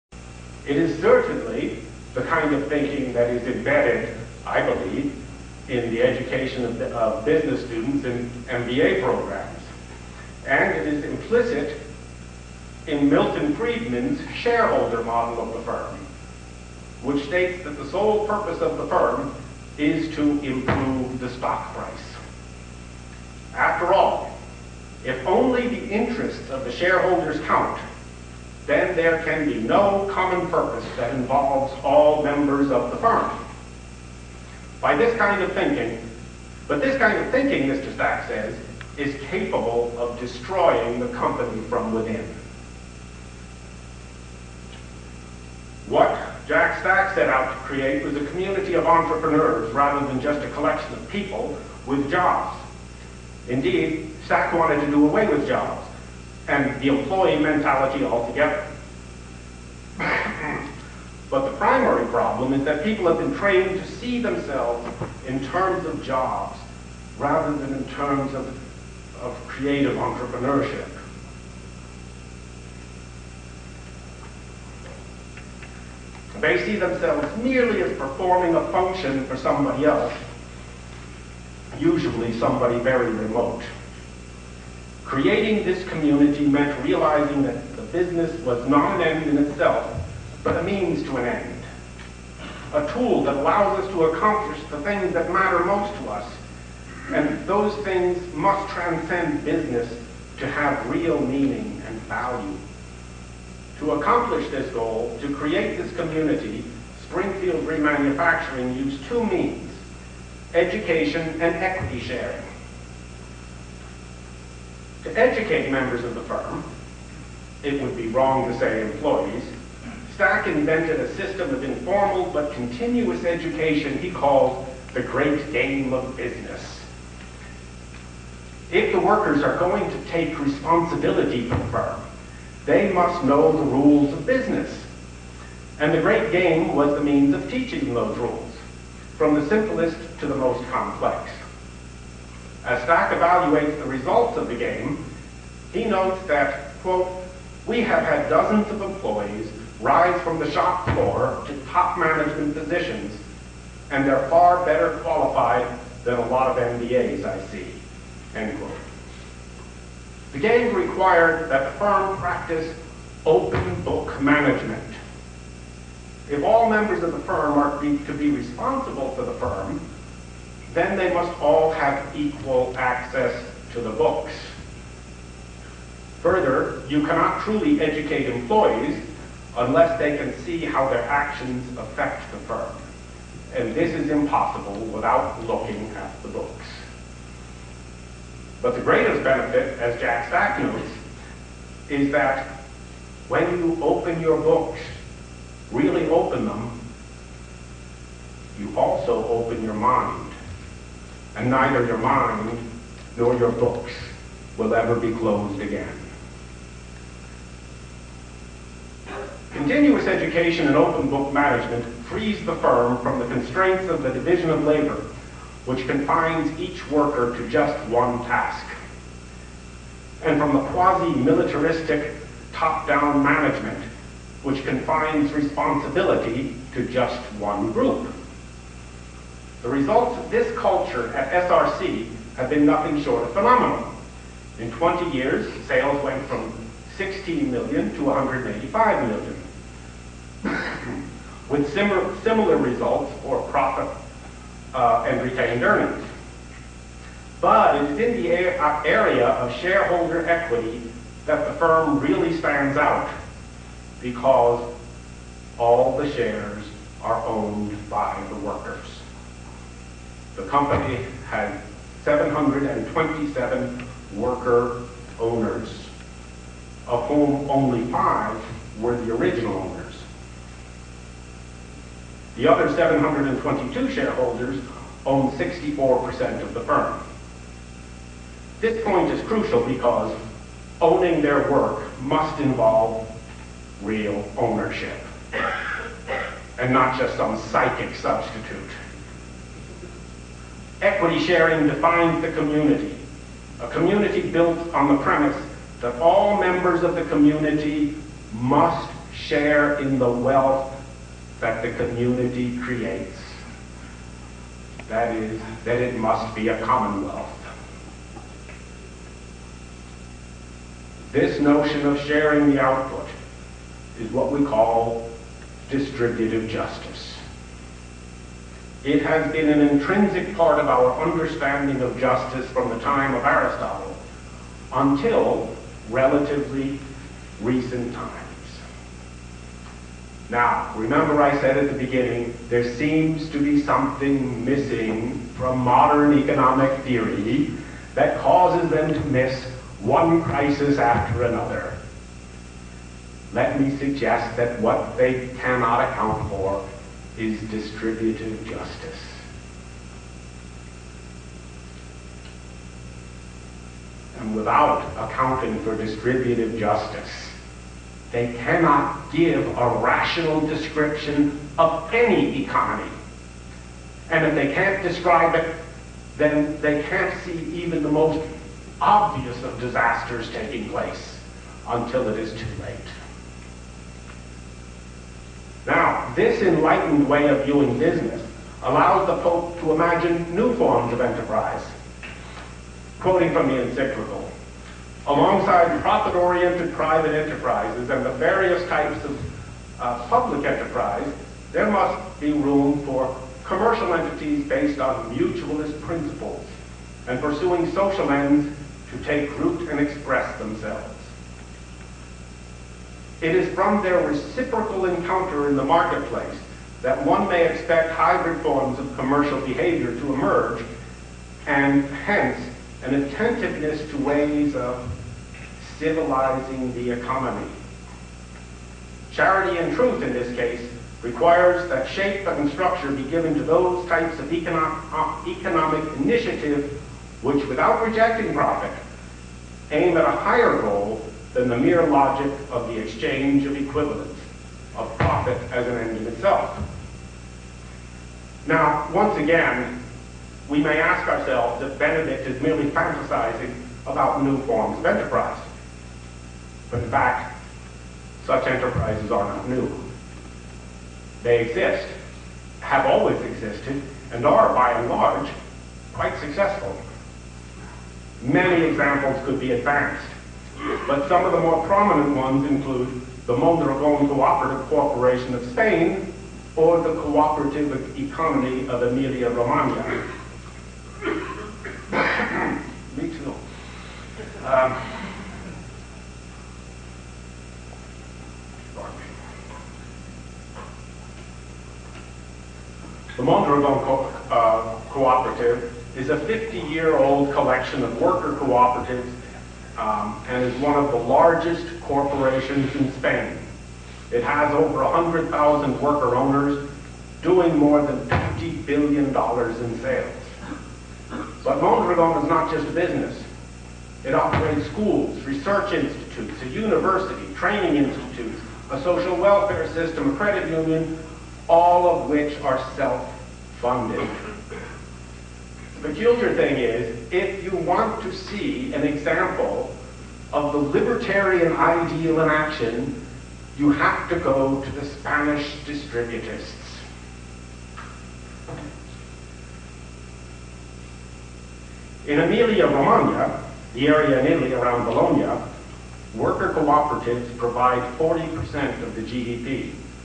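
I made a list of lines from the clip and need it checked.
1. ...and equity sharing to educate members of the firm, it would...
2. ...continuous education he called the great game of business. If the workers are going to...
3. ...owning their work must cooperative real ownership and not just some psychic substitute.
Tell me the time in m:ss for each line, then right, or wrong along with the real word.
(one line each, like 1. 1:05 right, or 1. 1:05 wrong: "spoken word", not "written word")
1. 1:51 right
2. 2:02 right
3. 4:40 wrong: "involve", not "cooperative".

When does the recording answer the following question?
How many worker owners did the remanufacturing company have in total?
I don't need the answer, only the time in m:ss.
4:22.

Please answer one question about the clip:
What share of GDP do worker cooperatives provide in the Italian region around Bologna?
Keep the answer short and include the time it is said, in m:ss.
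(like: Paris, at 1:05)
40%, at 8:57.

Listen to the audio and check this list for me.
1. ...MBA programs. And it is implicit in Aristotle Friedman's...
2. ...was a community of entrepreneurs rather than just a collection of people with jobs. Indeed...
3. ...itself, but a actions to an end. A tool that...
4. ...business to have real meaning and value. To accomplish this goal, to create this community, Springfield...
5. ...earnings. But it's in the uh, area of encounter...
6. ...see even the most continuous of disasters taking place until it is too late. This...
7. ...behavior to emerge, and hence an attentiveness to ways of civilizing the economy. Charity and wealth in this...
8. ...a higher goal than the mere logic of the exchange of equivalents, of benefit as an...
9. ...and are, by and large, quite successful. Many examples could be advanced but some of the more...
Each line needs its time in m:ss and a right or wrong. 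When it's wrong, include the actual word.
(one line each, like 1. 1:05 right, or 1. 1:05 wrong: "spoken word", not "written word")
1. 0:08 wrong: "Milton", not "Aristotle"
2. 0:48 right
3. 1:29 wrong: "means", not "actions"
4. 1:39 right
5. 4:05 wrong: "shareholder", not "encounter"
6. 6:07 wrong: "obvious", not "continuous"
7. 6:49 wrong: "truth", not "wealth"
8. 7:10 wrong: "profit", not "benefit"
9. 7:34 right.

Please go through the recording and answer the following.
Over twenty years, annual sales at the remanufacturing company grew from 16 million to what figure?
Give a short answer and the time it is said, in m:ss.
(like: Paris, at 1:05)
185 million, at 3:58.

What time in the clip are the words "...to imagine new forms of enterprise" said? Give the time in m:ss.
6:19.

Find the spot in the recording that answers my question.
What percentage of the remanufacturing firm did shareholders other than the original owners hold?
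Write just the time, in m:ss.
4:35.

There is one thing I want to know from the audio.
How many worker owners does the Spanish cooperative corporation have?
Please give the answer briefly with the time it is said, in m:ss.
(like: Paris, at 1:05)
Over 100,000, at 8:14.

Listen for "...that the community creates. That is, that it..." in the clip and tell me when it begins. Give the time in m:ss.
5:01.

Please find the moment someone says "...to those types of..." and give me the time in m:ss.
7:03.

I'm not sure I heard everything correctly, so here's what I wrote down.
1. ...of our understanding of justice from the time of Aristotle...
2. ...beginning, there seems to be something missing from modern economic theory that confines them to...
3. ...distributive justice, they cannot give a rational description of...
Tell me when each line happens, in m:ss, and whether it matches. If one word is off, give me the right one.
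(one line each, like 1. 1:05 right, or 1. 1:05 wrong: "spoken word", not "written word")
1. 5:20 right
2. 5:31 wrong: "causes", not "confines"
3. 5:55 right.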